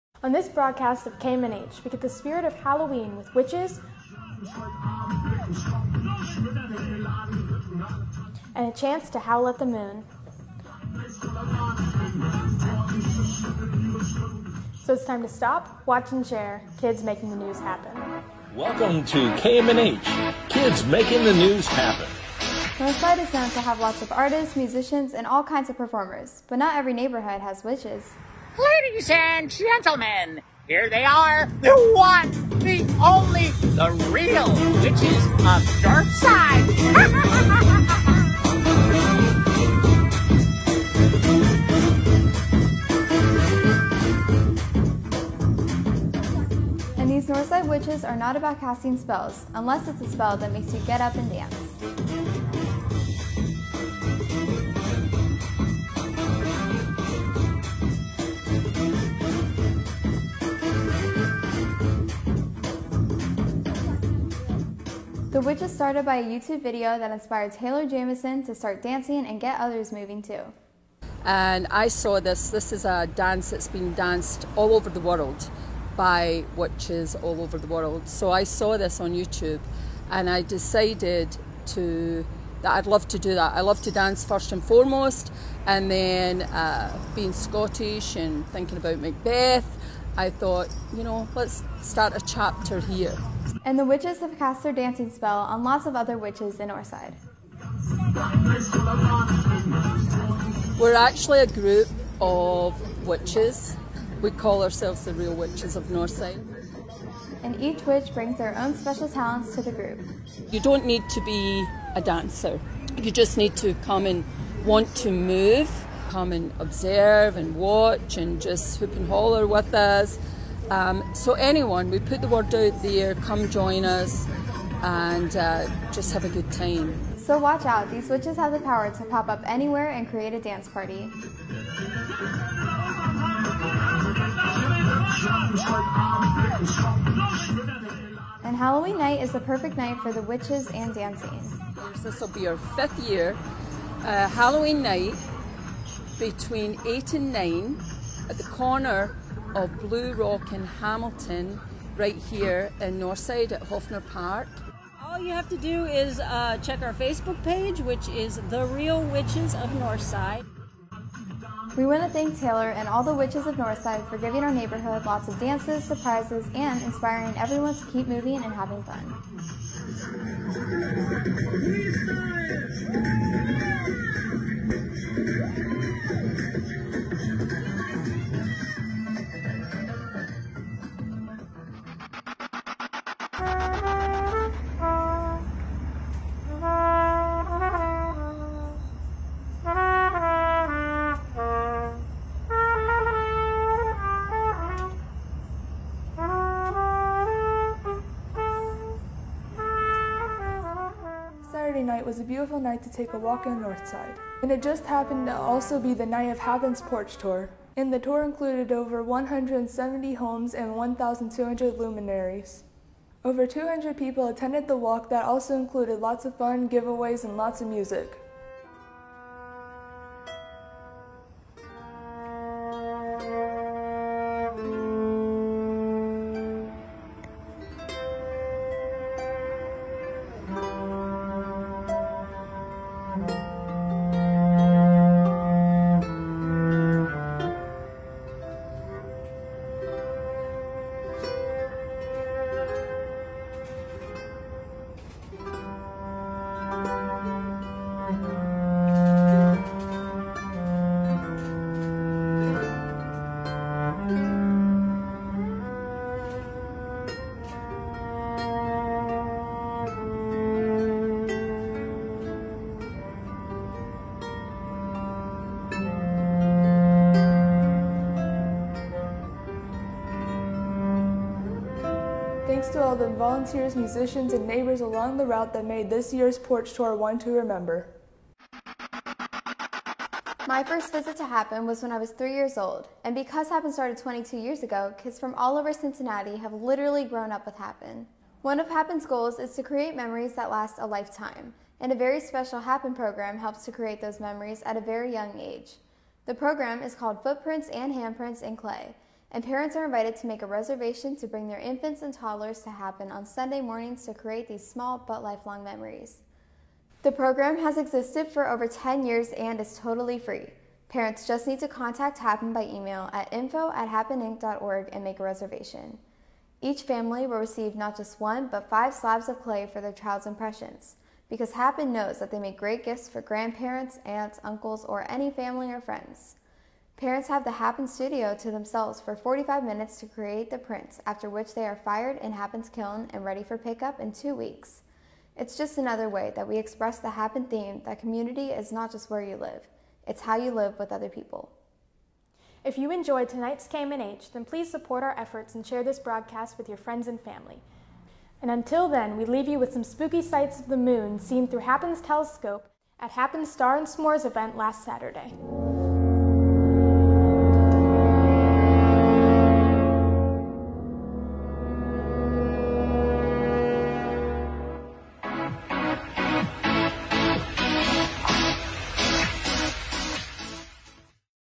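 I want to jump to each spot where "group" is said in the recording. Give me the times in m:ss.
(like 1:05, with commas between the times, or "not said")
1:41, 1:49.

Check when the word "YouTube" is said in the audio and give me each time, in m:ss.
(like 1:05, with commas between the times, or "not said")
1:06, 1:19.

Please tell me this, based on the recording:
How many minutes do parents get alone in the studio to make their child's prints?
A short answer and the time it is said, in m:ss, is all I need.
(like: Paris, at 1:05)
45, at 5:29.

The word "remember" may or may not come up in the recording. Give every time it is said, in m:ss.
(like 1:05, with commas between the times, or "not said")
4:37.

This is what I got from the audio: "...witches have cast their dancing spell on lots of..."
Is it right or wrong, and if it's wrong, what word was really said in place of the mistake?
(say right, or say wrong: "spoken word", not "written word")
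right.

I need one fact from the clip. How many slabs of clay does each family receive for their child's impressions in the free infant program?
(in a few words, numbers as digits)
5.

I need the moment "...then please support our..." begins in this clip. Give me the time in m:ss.
5:44.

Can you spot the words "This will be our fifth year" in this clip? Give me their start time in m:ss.
2:22.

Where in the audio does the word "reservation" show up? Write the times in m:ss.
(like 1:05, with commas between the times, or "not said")
5:00, 5:15.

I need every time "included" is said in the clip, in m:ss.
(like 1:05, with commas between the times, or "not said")
3:28, 3:35.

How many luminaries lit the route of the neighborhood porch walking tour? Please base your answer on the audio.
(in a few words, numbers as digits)
1,200.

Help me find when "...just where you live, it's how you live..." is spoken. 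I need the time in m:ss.
5:38.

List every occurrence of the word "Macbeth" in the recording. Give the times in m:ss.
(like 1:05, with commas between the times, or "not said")
1:28.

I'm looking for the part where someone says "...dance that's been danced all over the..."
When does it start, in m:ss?
1:13.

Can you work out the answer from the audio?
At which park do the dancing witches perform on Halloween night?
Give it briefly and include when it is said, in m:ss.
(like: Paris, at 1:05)
Hoffner Park, at 2:33.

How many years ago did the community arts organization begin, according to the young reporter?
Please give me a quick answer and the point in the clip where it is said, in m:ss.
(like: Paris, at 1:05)
22, at 4:43.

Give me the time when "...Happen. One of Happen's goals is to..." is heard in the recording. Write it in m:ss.
4:47.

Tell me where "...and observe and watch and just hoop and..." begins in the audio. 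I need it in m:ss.
1:56.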